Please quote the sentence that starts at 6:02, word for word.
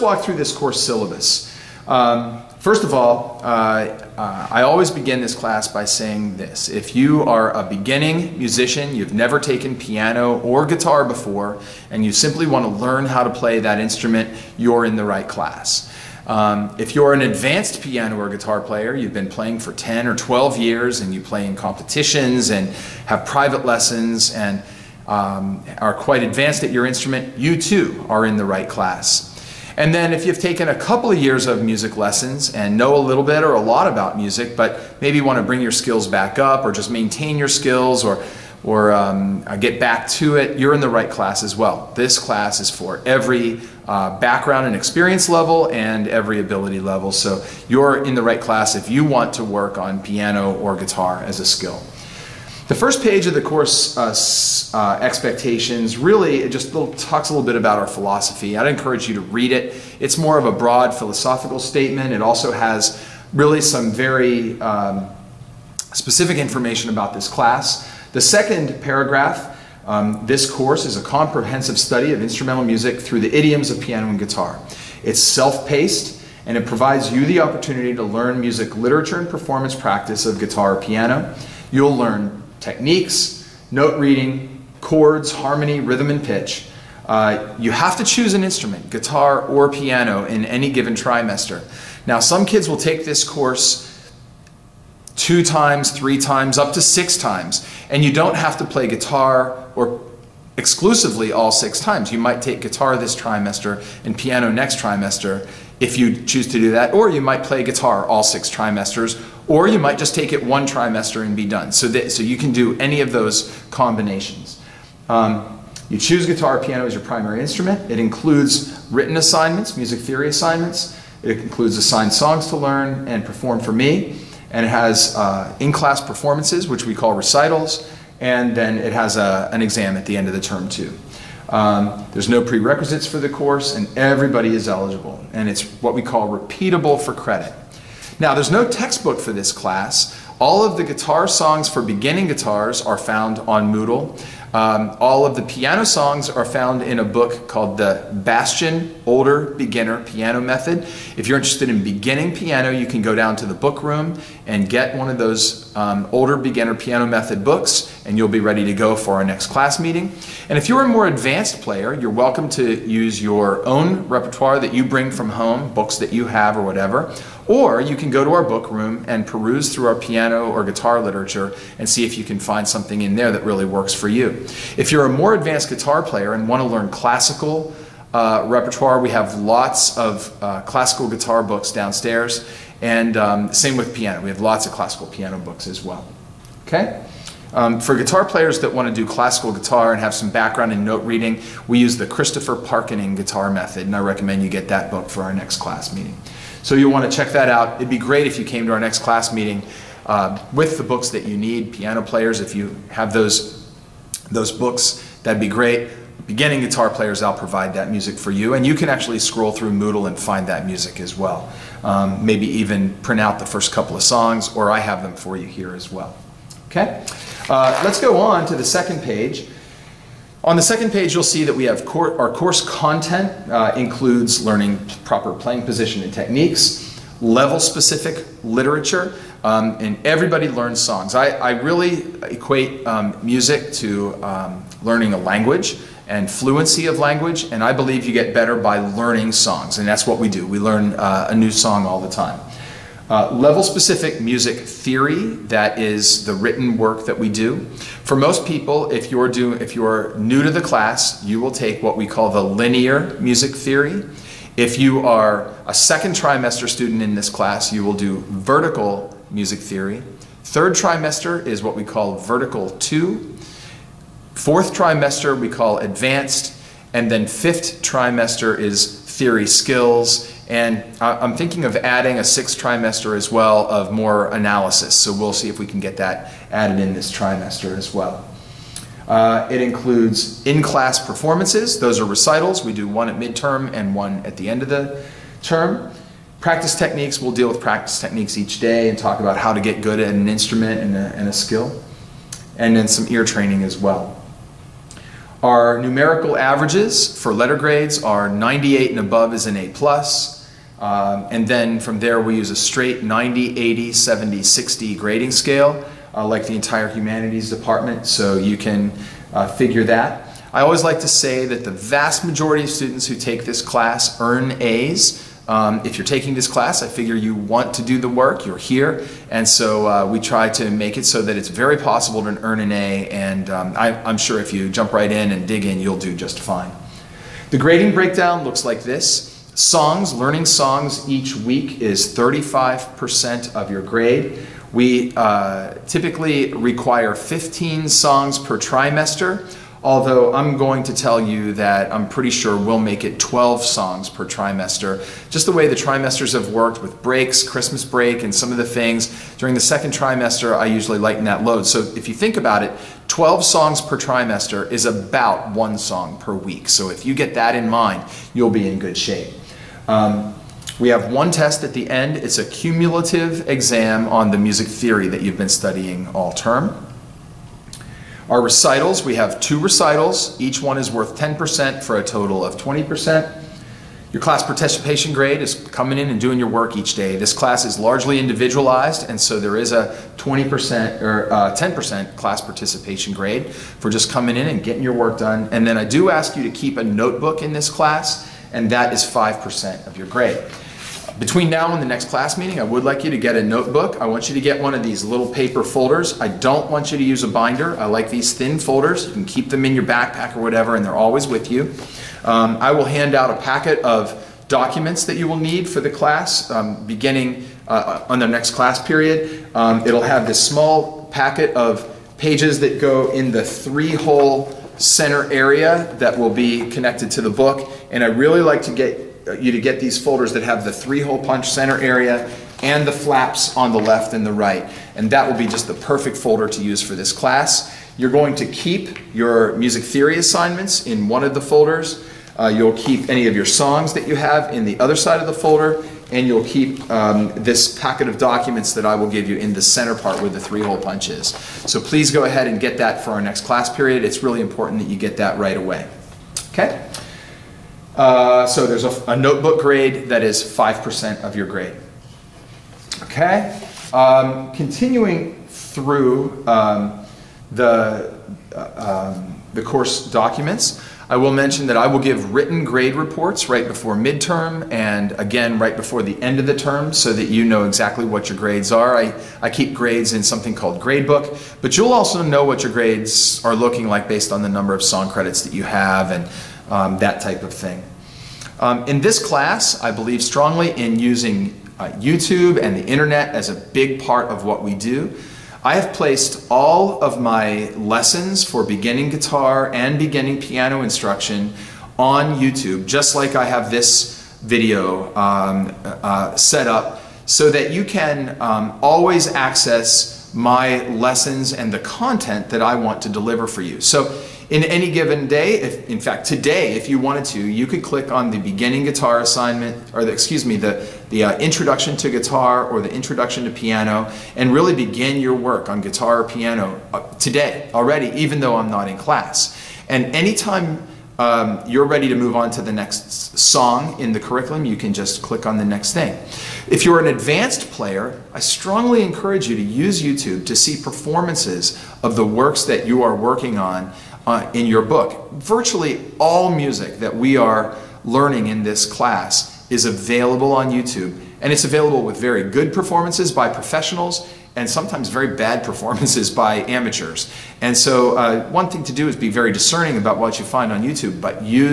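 It's a cumulative exam on the music theory that you've been studying all term.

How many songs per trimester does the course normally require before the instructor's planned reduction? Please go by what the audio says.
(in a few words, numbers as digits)
15.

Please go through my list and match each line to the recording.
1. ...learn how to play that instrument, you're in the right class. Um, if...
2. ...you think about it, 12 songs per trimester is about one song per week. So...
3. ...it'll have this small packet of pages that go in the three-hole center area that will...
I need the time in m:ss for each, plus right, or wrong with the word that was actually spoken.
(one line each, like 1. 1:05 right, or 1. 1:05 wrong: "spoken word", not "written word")
1. 0:12 right
2. 5:52 right
3. 6:49 right.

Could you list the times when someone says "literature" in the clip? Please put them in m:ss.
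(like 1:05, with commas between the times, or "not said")
1:18, 2:51, 3:48.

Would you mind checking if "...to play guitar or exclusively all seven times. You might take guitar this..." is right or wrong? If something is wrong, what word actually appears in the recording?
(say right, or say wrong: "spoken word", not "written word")
wrong: "six", not "seven".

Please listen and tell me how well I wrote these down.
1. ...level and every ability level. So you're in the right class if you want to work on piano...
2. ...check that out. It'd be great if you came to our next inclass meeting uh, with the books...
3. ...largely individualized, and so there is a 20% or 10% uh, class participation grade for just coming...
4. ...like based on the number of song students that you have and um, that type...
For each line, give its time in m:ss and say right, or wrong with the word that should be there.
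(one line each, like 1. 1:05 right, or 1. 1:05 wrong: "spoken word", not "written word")
1. 0:45 right
2. 3:17 wrong: "class", not "inclass"
3. 6:17 right
4. 7:53 wrong: "credits", not "students".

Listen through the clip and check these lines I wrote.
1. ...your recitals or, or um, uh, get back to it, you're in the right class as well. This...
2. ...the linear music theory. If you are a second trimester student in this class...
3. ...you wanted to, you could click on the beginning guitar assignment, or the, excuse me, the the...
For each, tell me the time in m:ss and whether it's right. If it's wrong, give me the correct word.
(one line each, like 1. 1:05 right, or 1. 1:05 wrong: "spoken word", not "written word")
1. 0:37 wrong: "skills", not "recitals"
2. 4:12 right
3. 8:26 right.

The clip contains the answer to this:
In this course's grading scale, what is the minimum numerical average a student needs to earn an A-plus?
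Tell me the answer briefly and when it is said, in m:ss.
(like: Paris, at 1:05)
98, at 4:58.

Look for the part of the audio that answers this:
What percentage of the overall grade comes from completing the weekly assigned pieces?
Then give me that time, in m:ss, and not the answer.
5:32.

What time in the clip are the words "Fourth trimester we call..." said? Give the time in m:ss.
4:24.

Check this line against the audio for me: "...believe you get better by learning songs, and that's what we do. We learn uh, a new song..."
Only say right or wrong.
right.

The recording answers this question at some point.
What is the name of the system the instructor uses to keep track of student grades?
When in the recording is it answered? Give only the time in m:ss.
7:50.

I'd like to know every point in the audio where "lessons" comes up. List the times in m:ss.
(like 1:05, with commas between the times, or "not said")
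0:23, 0:31, 8:07, 8:20.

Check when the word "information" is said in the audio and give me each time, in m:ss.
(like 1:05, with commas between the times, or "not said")
1:06.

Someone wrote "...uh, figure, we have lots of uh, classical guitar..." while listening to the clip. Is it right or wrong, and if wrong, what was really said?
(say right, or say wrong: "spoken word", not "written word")
wrong: "repertoire", not "figure".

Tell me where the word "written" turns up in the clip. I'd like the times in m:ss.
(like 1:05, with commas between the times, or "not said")
1:58, 4:06, 7:42.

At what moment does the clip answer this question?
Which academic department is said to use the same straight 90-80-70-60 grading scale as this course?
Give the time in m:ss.
5:06.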